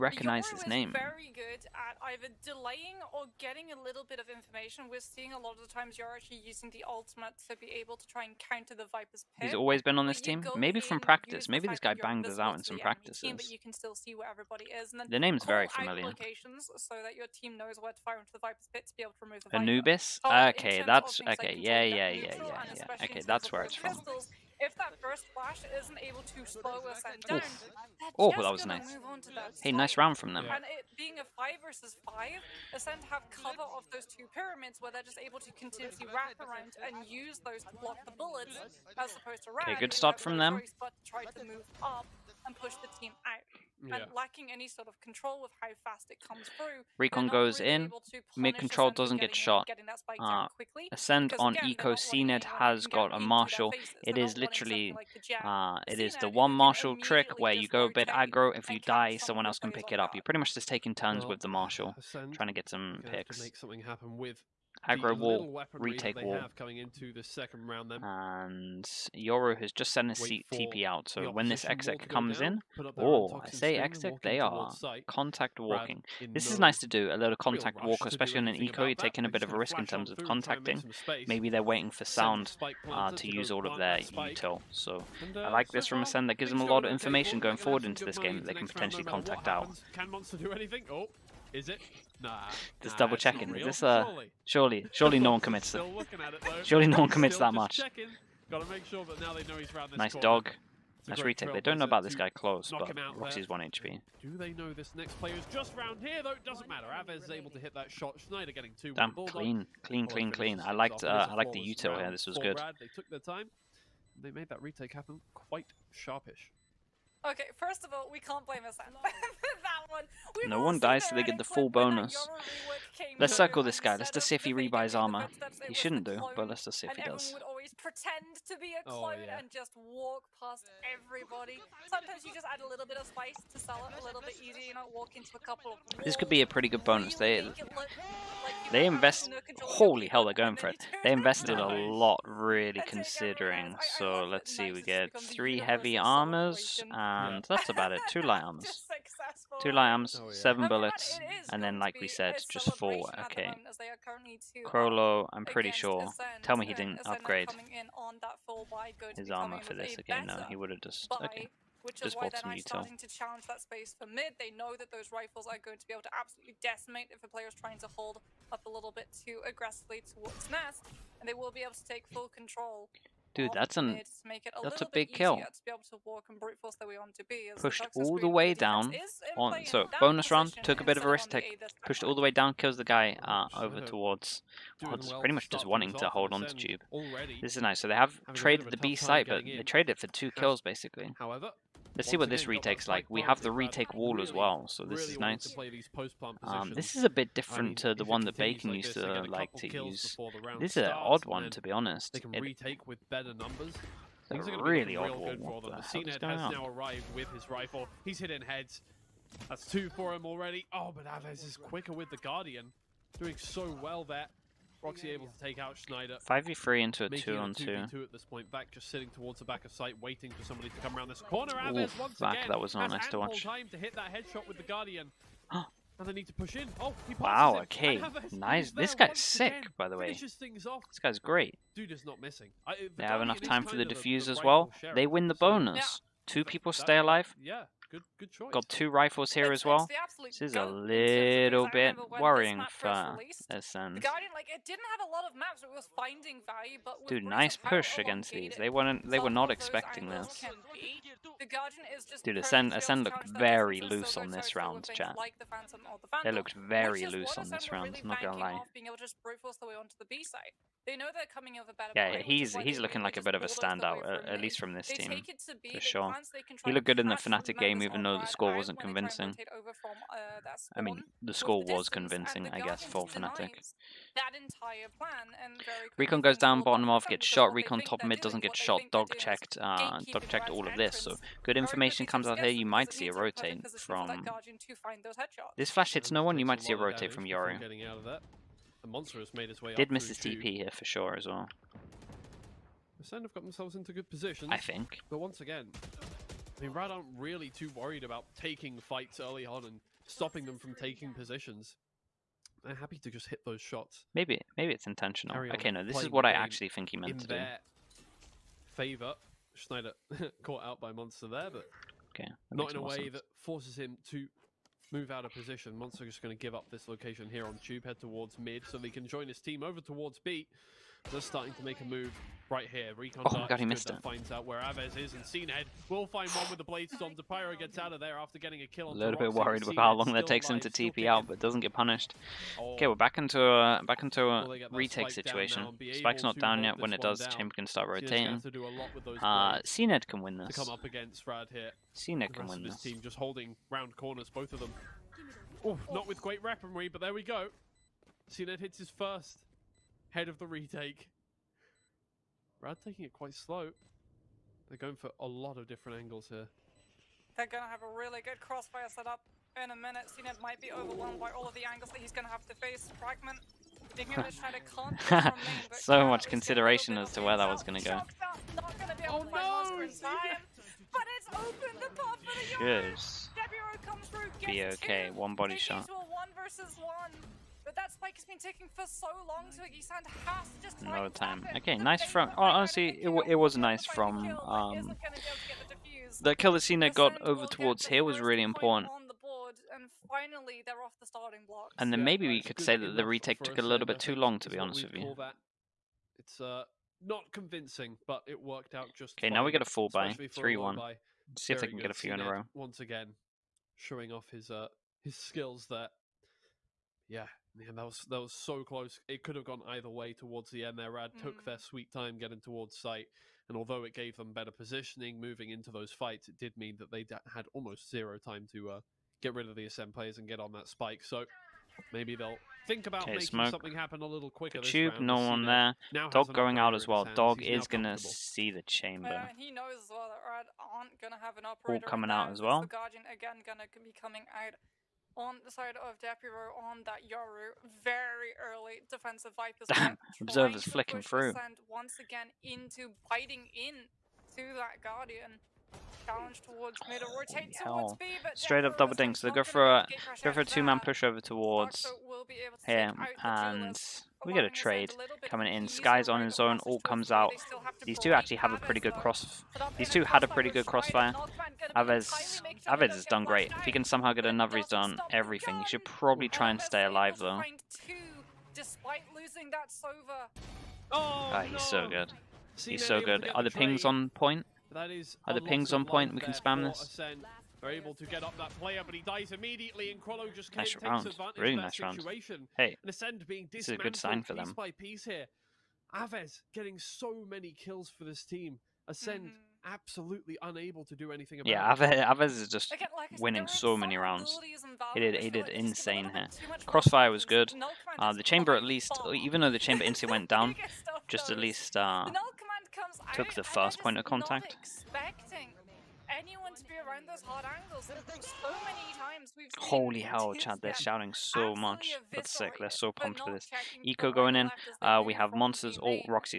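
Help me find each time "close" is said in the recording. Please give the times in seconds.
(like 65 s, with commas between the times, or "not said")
102 s, 408 s.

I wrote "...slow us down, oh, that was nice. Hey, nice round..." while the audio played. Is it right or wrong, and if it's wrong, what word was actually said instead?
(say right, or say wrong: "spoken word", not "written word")
right.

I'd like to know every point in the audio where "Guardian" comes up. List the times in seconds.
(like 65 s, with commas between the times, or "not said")
212 s, 224 s, 432 s, 444 s.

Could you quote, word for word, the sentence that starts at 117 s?
Okay, first of all, we can't blame us.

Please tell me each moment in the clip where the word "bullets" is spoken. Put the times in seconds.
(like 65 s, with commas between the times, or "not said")
38 s, 150 s.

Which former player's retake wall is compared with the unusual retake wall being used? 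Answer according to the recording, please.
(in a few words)
Bacon.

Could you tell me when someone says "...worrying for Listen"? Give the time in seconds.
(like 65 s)
242 s.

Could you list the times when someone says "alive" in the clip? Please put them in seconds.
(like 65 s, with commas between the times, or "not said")
236 s, 466 s.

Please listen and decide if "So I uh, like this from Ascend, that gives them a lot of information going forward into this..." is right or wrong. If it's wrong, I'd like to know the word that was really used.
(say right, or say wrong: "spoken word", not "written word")
right.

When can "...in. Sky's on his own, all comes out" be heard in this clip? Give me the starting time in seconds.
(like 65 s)
455 s.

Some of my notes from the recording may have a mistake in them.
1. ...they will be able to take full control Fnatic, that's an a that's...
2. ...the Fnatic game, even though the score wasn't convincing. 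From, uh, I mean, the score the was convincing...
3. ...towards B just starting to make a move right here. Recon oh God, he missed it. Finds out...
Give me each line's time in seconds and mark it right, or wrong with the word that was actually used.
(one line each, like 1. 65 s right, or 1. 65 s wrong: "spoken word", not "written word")
1. 171 s wrong: "Dude", not "Fnatic"
2. 267 s right
3. 319 s right.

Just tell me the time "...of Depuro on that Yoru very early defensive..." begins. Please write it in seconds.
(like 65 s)
435 s.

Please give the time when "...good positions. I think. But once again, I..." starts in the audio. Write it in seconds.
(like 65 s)
293 s.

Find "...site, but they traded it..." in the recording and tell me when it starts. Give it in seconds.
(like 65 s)
188 s.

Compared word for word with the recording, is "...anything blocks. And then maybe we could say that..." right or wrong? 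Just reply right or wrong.
wrong.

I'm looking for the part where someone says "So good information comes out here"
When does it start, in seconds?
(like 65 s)
281 s.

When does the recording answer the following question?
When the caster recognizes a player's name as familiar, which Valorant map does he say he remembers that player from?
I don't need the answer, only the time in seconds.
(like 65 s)
19 s.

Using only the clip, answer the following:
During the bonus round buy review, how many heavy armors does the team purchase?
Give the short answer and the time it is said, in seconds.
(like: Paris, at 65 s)
3, at 145 s.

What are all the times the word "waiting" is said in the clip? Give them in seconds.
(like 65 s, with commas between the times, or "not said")
81 s, 220 s.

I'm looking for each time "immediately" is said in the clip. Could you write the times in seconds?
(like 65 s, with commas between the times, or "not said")
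479 s.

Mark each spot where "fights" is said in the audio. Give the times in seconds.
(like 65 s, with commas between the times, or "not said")
298 s, 415 s.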